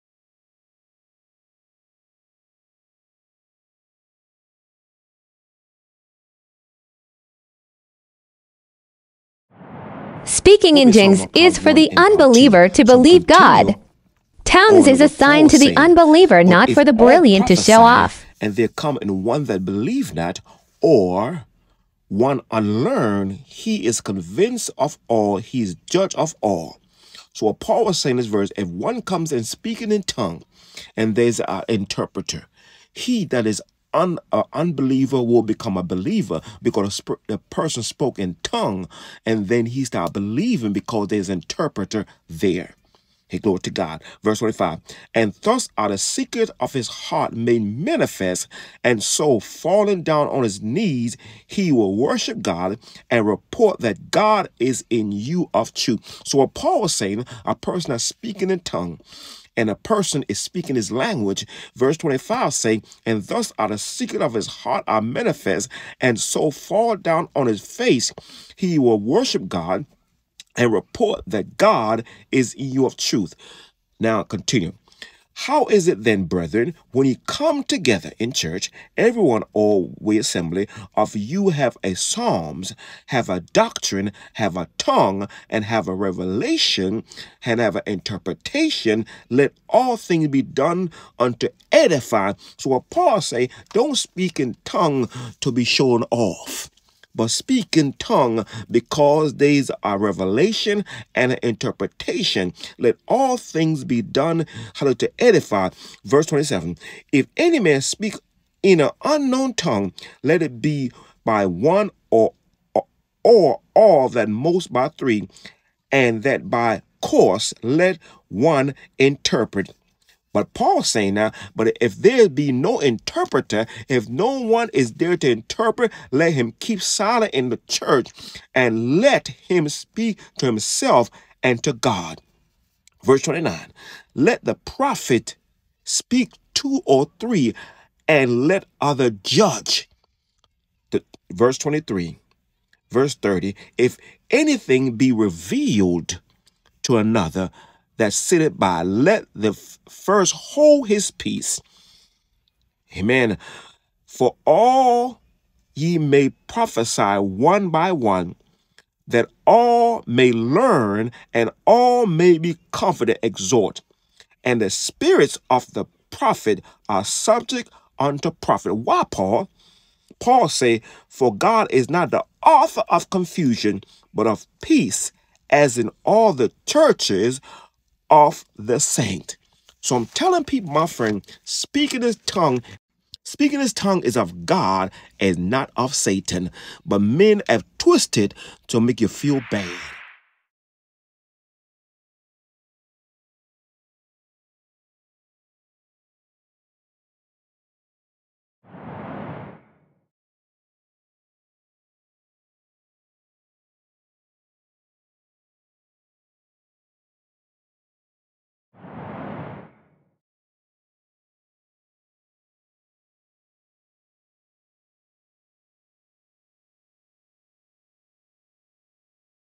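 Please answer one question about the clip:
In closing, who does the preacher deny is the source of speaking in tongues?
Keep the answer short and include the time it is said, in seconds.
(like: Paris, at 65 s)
Satan, at 185 s.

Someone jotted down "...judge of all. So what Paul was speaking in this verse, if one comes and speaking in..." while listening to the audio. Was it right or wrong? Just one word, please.
wrong.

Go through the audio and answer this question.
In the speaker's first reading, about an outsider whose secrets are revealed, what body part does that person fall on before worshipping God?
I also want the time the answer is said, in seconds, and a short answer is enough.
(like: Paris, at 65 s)
Knees, at 50 s.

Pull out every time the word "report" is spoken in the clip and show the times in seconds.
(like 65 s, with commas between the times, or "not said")
53 s, 70 s.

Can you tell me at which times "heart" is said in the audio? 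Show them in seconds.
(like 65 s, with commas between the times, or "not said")
46 s, 64 s.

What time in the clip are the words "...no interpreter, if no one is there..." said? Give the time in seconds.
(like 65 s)
122 s.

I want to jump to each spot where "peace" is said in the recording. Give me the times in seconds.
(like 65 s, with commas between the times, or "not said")
151 s, 174 s.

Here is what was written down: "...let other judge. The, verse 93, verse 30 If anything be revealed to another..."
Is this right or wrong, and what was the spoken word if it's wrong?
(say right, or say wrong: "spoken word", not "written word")
wrong: "23", not "93".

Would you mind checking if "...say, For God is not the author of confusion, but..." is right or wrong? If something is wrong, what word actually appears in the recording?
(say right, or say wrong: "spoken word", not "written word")
right.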